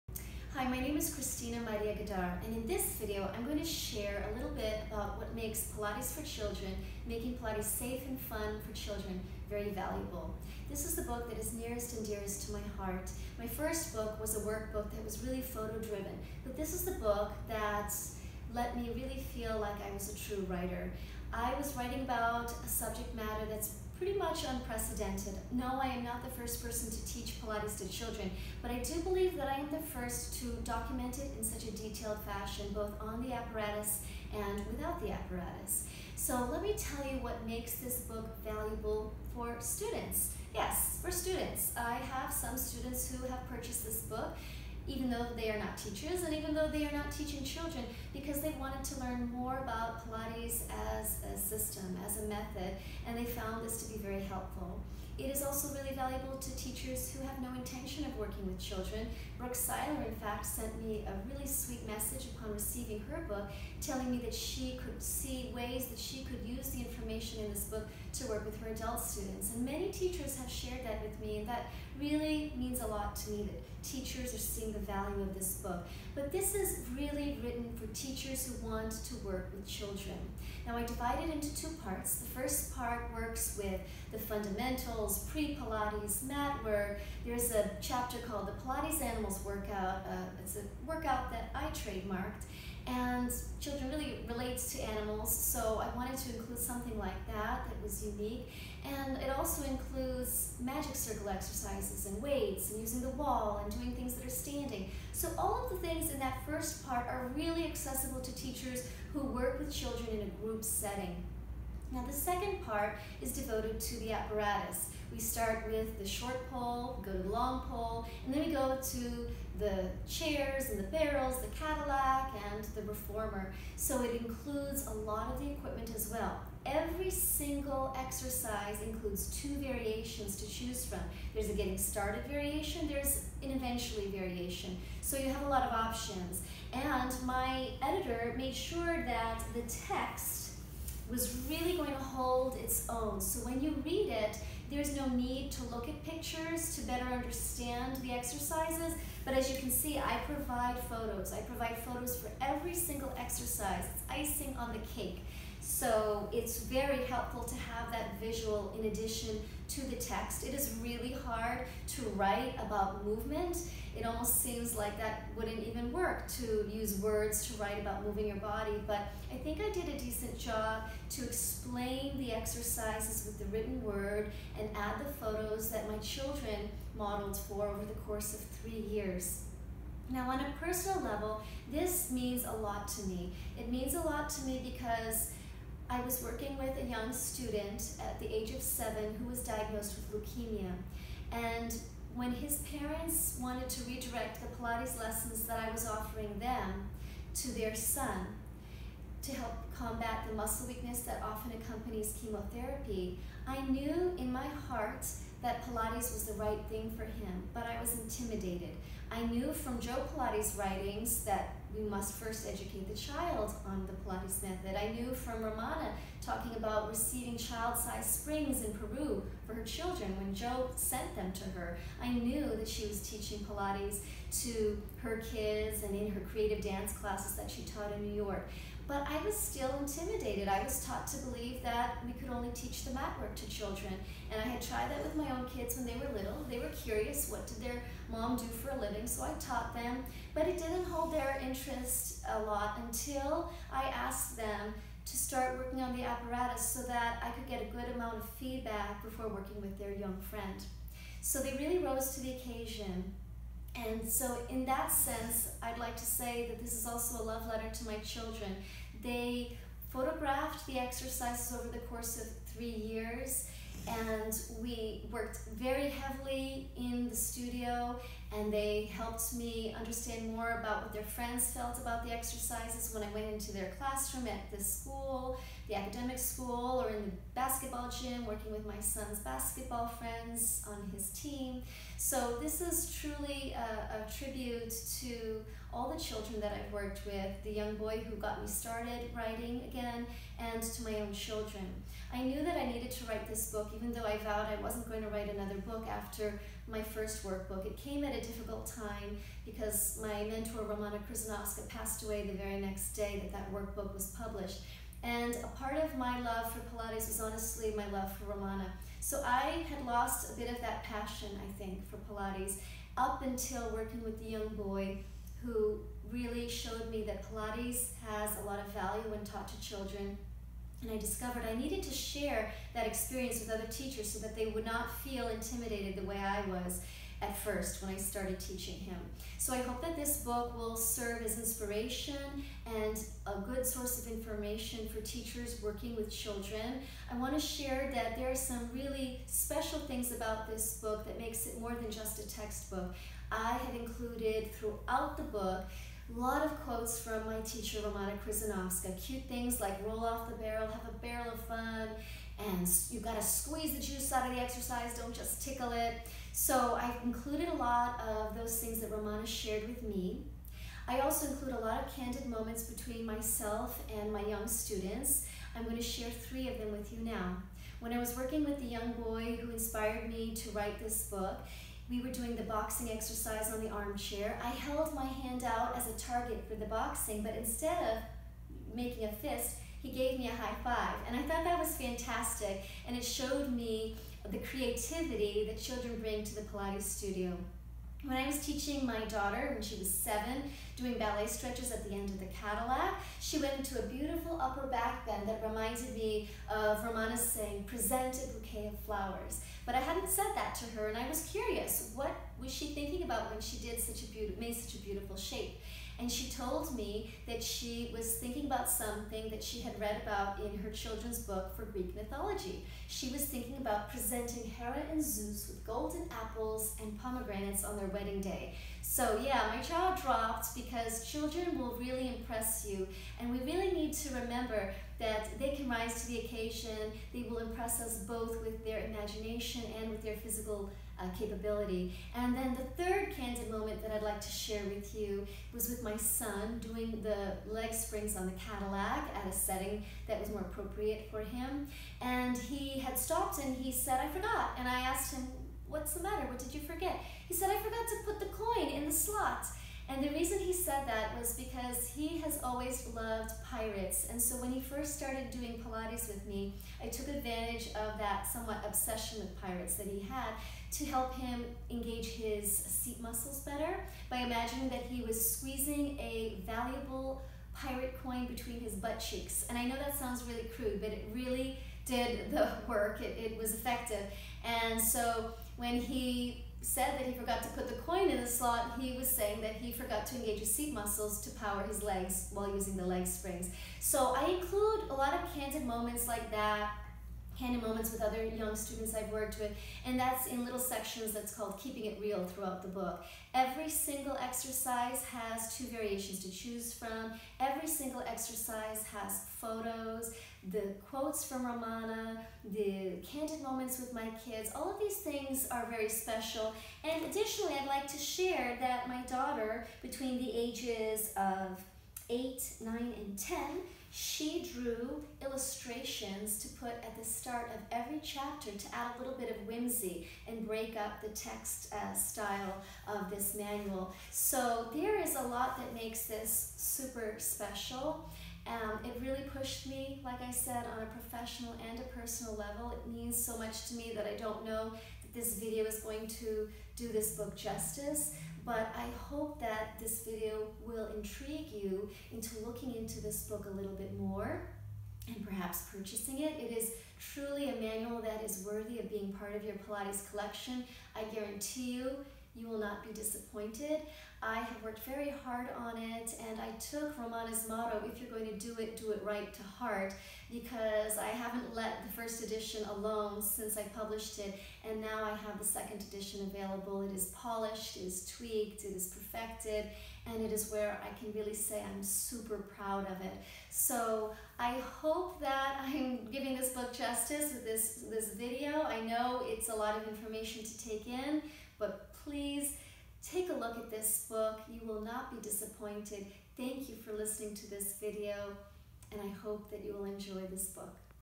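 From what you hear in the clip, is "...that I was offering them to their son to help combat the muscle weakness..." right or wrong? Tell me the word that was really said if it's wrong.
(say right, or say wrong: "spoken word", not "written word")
right.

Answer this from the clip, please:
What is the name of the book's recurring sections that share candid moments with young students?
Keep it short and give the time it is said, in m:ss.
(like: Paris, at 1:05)
Keeping It Real, at 8:11.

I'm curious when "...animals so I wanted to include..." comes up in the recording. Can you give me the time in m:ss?
1:34.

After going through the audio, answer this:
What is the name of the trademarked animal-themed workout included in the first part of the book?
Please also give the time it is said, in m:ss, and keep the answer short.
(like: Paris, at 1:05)
Pilates Animals Workout, at 1:28.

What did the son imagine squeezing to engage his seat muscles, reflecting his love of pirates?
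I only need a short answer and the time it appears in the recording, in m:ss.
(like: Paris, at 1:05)
pirate coin, at 7:47.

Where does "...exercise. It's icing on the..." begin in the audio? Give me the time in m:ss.
2:33.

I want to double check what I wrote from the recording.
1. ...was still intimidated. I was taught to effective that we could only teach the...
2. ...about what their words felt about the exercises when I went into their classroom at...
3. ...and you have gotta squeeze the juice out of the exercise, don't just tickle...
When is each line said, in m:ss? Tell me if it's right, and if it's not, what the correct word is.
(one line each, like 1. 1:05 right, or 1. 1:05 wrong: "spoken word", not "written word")
1. 3:49 wrong: "believe", not "effective"
2. 4:30 wrong: "friends", not "words"
3. 5:52 right.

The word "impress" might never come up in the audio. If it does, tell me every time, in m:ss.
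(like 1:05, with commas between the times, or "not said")
7:02, 7:07.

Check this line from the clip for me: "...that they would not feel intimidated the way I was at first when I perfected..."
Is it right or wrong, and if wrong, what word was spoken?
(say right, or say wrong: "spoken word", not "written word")
wrong: "started", not "perfected".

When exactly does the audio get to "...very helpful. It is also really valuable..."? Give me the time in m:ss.
0:54.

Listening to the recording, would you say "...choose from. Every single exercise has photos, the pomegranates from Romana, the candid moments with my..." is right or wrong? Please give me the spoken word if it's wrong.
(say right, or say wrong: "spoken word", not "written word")
wrong: "quotes", not "pomegranates".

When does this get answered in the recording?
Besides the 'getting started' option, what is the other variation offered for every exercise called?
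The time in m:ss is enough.
2:13.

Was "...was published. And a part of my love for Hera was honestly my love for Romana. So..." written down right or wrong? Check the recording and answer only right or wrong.
wrong.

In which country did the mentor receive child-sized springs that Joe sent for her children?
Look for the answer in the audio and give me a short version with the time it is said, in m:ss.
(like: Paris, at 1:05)
Peru, at 3:38.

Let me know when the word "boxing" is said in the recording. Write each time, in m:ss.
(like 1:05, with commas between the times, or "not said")
6:12, 6:16.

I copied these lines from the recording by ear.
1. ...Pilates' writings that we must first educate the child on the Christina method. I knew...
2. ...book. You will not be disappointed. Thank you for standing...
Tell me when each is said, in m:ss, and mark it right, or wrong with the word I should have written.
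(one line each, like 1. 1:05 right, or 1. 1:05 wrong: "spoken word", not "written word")
1. 3:30 wrong: "Pilates", not "Christina"
2. 9:44 wrong: "listening", not "standing".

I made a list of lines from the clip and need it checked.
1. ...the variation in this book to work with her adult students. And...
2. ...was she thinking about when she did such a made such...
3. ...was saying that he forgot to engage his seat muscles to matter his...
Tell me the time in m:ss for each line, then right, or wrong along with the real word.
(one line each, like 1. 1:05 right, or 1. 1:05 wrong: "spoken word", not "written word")
1. 1:06 wrong: "information", not "variation"
2. 6:42 right
3. 7:58 wrong: "power", not "matter".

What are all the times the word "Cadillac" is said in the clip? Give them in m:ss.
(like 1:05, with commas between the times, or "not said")
2:01, 6:32, 7:18.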